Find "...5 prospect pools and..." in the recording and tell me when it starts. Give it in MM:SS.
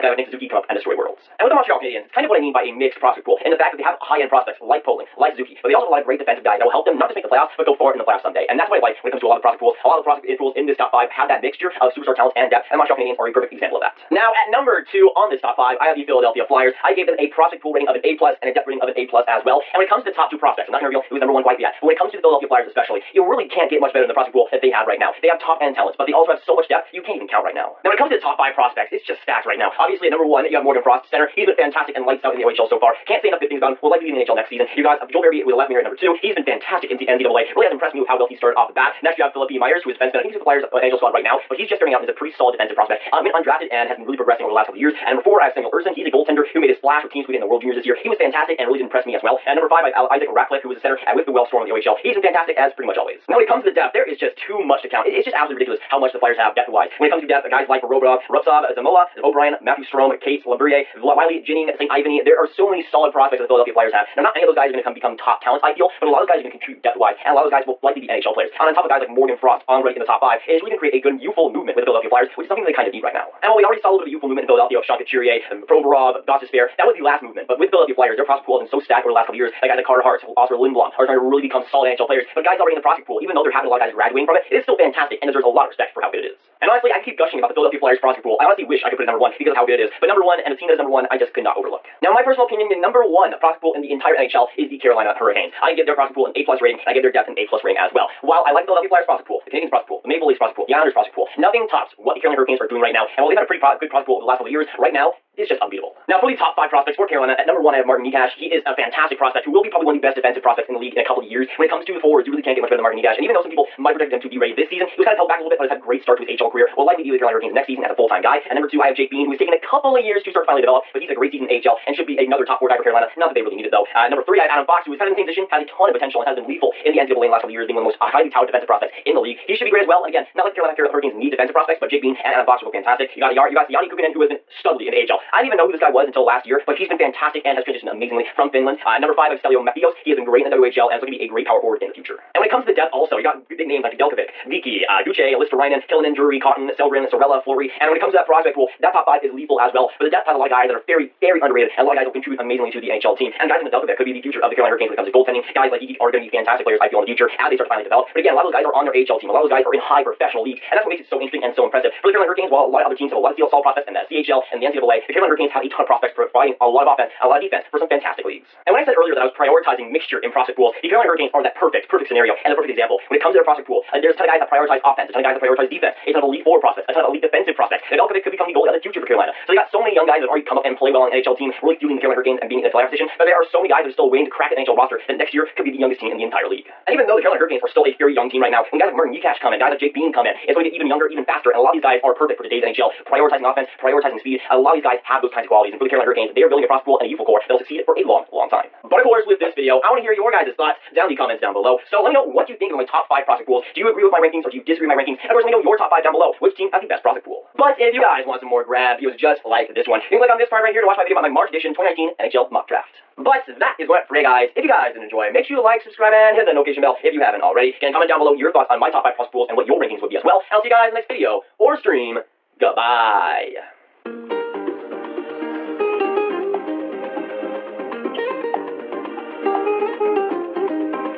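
03:39.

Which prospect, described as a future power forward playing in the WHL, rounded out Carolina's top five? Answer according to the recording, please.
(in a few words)
Stelio Mattheos.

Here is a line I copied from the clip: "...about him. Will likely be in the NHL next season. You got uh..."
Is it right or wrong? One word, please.
right.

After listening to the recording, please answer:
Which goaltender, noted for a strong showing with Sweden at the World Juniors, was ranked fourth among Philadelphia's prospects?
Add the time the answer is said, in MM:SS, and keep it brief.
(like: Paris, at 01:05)
Samuel Ersson, at 00:45.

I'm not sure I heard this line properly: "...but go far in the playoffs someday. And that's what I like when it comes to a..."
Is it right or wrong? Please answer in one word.
right.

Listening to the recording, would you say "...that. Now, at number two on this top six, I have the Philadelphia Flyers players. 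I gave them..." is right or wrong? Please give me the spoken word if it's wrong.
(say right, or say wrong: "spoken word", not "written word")
wrong: "five", not "six".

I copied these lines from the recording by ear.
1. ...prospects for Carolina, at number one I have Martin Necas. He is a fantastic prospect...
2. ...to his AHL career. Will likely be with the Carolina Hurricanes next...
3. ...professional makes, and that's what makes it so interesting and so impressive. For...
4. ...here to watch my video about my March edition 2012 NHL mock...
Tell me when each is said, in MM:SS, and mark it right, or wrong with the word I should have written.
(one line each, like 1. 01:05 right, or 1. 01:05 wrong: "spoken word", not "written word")
1. 01:46 right
2. 01:56 right
3. 02:40 wrong: "leagues", not "makes"
4. 03:30 wrong: "2019", not "2012".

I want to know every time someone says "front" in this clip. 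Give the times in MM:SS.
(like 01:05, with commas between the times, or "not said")
not said.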